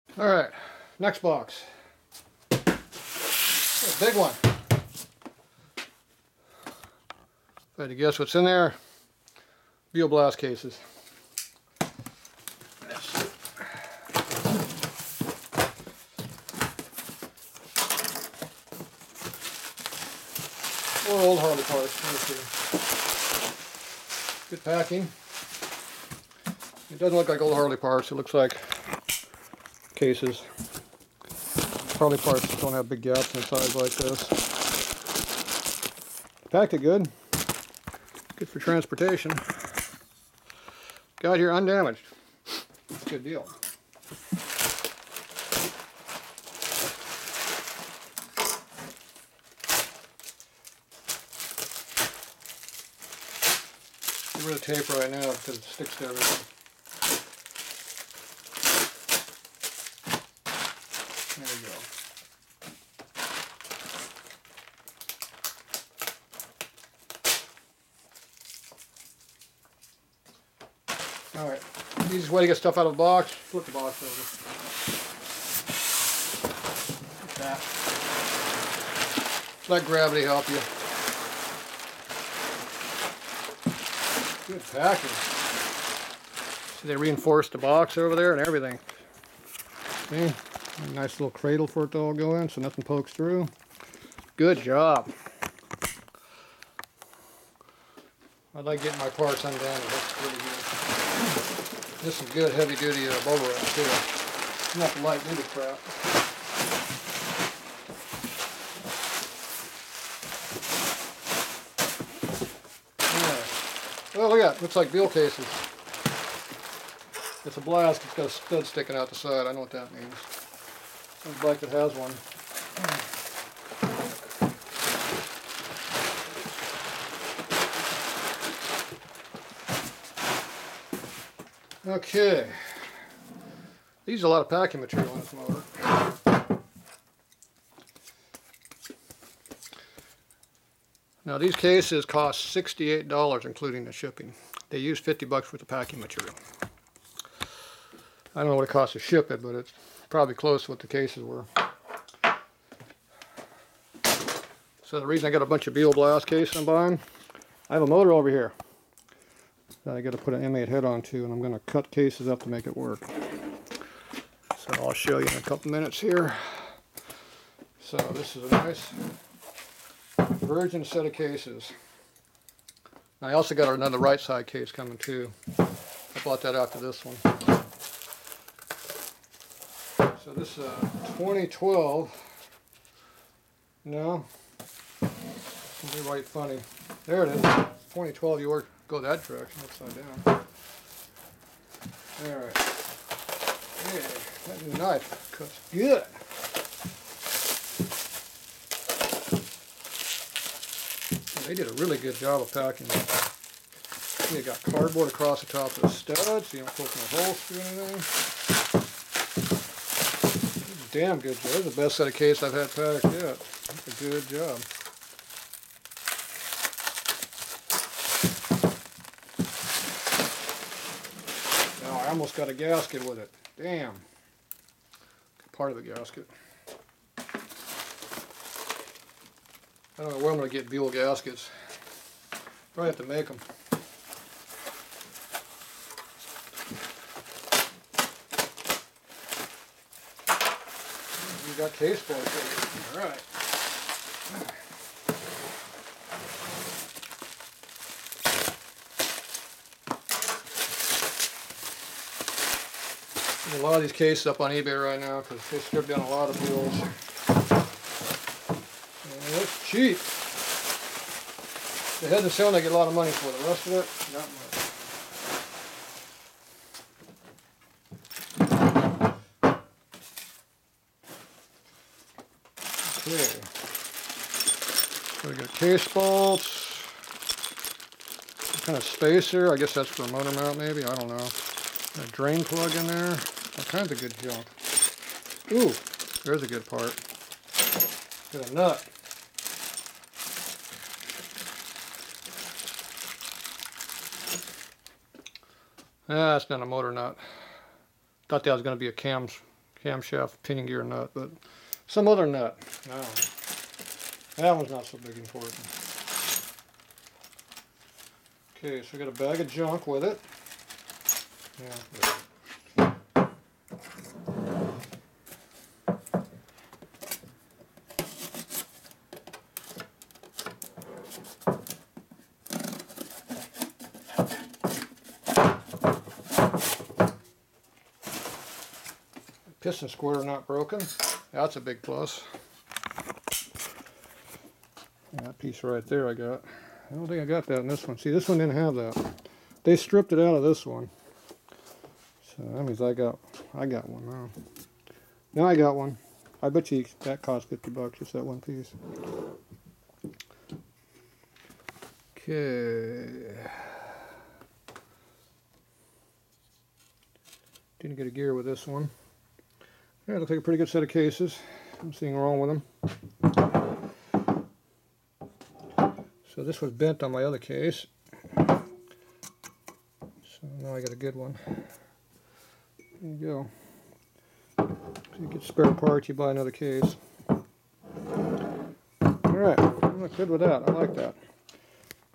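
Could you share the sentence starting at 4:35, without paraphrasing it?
So we got case bolts, kind of spacer.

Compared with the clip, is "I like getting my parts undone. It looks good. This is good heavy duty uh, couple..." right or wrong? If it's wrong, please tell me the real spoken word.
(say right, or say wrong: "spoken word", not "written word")
wrong: "bubble", not "couple".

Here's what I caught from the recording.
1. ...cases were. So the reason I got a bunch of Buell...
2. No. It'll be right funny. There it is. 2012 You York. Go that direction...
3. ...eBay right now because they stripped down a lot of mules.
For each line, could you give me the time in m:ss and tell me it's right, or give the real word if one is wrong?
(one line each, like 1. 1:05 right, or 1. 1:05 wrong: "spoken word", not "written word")
1. 2:30 right
2. 3:03 right
3. 4:14 right.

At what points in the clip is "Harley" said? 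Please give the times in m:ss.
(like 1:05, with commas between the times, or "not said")
0:21, 0:27.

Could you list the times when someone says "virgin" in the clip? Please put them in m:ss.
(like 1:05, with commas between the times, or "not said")
2:50.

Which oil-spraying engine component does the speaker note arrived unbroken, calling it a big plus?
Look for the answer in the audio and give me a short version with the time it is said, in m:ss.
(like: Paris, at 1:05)
Piston squirter, at 5:29.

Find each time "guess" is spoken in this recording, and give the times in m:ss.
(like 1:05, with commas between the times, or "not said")
0:07, 4:39.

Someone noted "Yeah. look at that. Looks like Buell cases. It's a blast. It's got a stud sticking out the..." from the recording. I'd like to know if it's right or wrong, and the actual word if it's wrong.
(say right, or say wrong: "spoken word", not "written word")
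right.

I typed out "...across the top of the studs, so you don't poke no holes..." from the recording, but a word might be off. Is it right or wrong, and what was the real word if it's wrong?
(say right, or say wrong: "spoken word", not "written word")
right.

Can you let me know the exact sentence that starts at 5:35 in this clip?
That piece right there I got.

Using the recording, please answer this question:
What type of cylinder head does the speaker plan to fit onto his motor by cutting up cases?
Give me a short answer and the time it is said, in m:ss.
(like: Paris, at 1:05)
M8, at 2:40.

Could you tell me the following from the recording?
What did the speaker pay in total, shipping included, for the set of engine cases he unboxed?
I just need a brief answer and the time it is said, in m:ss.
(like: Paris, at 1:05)
$68, at 2:22.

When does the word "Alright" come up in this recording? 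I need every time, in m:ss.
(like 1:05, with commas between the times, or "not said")
3:12, 6:18.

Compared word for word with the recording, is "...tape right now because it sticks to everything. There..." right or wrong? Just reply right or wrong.
right.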